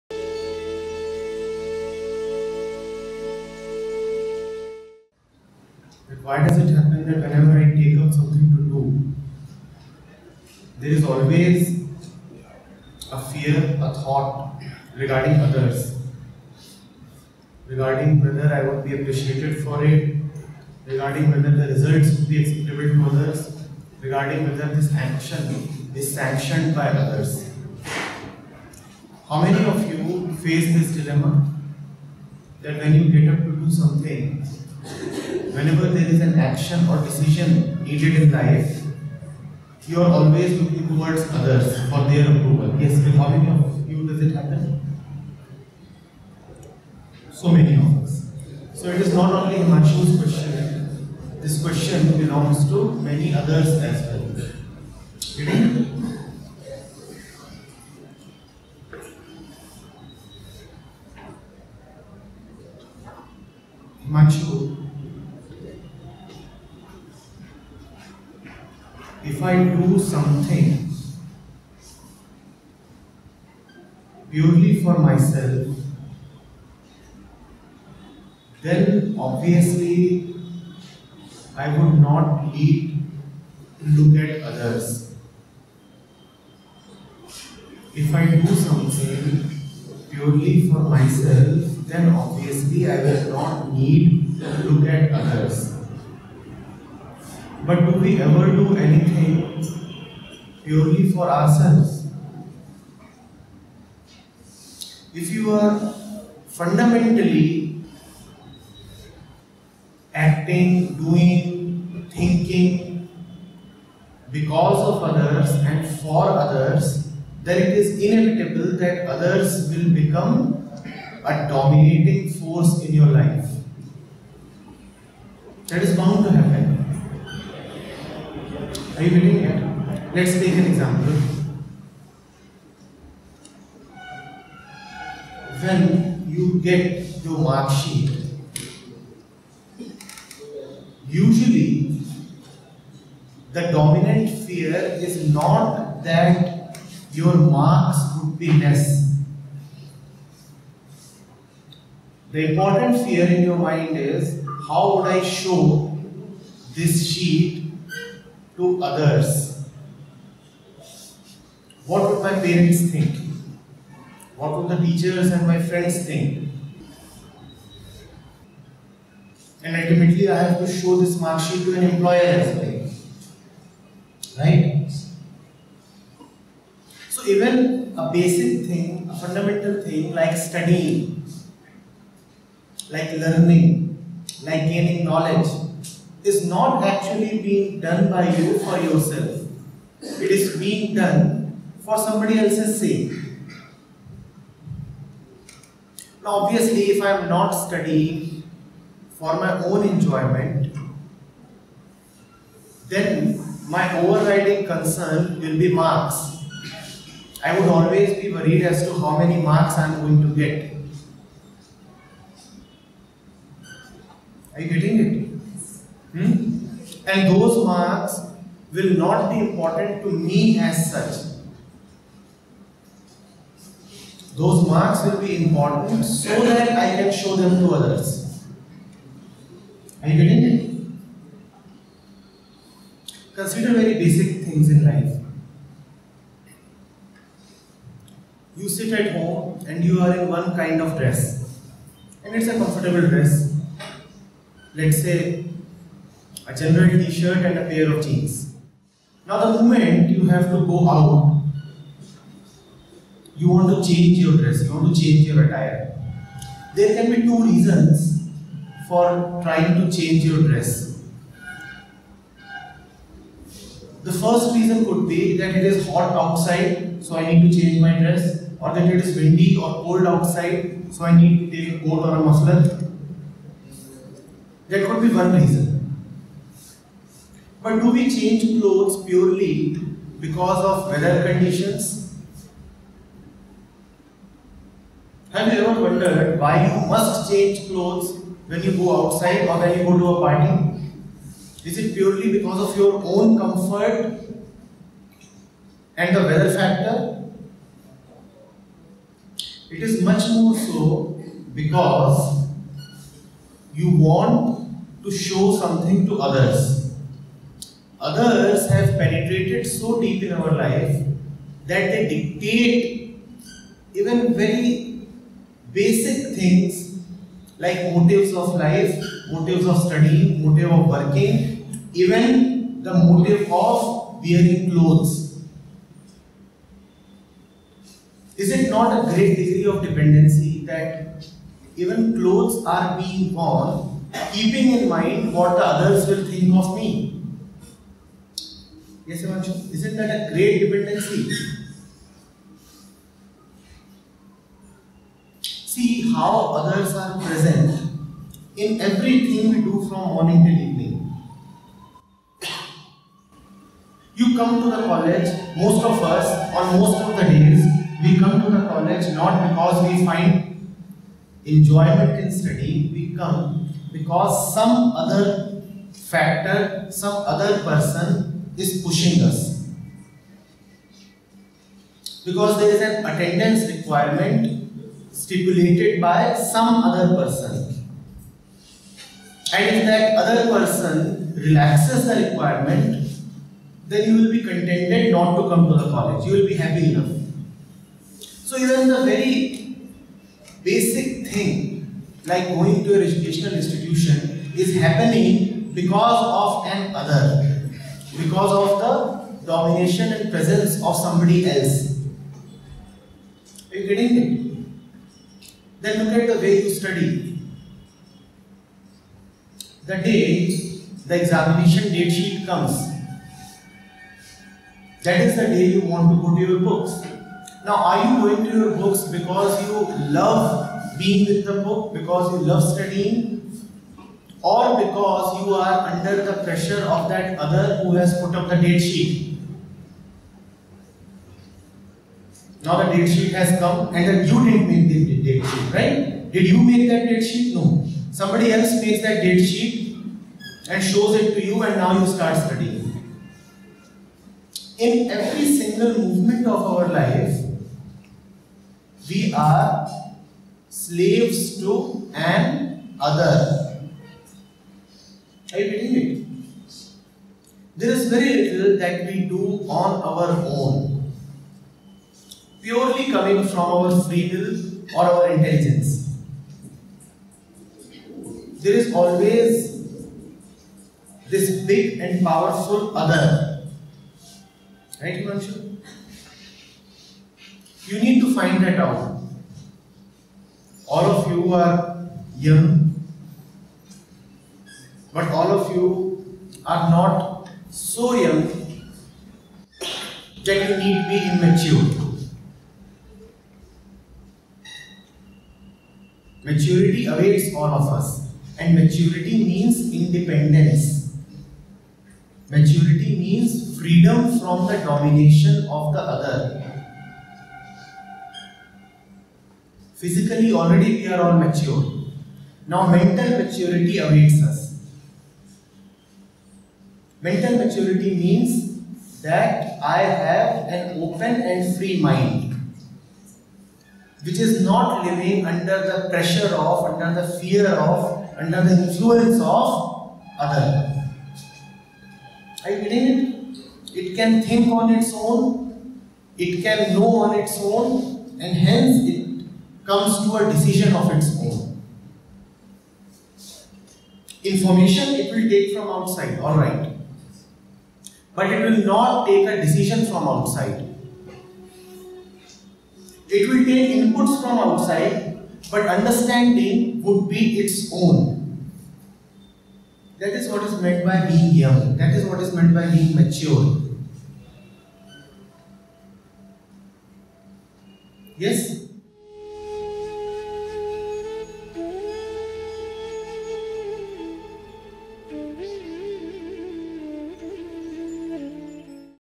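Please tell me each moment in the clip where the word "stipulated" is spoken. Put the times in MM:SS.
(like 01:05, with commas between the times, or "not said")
06:15.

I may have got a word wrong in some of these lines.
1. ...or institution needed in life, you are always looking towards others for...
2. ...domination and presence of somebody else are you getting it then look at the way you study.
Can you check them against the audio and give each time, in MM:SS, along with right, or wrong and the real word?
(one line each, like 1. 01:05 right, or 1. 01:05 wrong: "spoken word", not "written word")
1. 00:36 wrong: "decision", not "institution"
2. 06:39 right.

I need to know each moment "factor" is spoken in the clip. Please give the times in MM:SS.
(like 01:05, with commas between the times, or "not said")
04:56, 06:05.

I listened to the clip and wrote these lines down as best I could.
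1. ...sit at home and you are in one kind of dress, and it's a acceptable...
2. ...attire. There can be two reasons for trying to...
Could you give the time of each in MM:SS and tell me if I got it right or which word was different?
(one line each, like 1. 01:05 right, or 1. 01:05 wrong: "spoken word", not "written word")
1. 03:58 wrong: "comfortable", not "acceptable"
2. 04:15 right.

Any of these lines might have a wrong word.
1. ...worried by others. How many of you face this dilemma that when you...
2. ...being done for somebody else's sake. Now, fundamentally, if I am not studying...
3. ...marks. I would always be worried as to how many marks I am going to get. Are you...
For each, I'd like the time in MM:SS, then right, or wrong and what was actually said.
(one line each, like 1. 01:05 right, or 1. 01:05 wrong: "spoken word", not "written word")
1. 00:26 wrong: "sanctioned", not "worried"
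2. 03:10 wrong: "obviously", not "fundamentally"
3. 03:25 right.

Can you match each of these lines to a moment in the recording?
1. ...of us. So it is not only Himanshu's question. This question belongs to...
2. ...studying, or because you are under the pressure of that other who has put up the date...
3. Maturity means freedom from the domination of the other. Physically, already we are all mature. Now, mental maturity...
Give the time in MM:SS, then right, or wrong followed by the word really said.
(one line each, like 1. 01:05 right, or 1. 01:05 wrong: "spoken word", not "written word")
1. 00:47 right
2. 07:02 right
3. 08:22 right.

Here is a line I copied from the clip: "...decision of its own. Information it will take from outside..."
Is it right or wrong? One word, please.
right.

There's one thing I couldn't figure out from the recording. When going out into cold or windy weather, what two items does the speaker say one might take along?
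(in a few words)
A coat or a muffler.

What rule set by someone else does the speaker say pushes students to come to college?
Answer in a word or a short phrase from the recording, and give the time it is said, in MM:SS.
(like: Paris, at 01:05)
Attendance requirement, at 06:13.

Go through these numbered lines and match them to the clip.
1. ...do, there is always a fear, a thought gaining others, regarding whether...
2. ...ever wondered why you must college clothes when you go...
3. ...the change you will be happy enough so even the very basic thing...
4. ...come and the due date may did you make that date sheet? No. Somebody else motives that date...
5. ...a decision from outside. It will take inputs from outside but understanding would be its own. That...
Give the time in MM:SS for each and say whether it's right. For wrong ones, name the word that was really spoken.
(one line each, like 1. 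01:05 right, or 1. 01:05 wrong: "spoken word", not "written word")
1. 00:08 wrong: "regarding", not "gaining"
2. 04:45 wrong: "change", not "college"
3. 06:25 wrong: "college", not "change"
4. 07:13 wrong: "makes", not "motives"
5. 09:09 right.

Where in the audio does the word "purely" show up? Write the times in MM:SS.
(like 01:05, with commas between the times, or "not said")
01:14, 01:30, 01:40, 04:39, 04:51, 07:42.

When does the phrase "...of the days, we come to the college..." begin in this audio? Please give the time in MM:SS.
05:57.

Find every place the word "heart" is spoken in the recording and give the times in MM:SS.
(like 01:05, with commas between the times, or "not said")
not said.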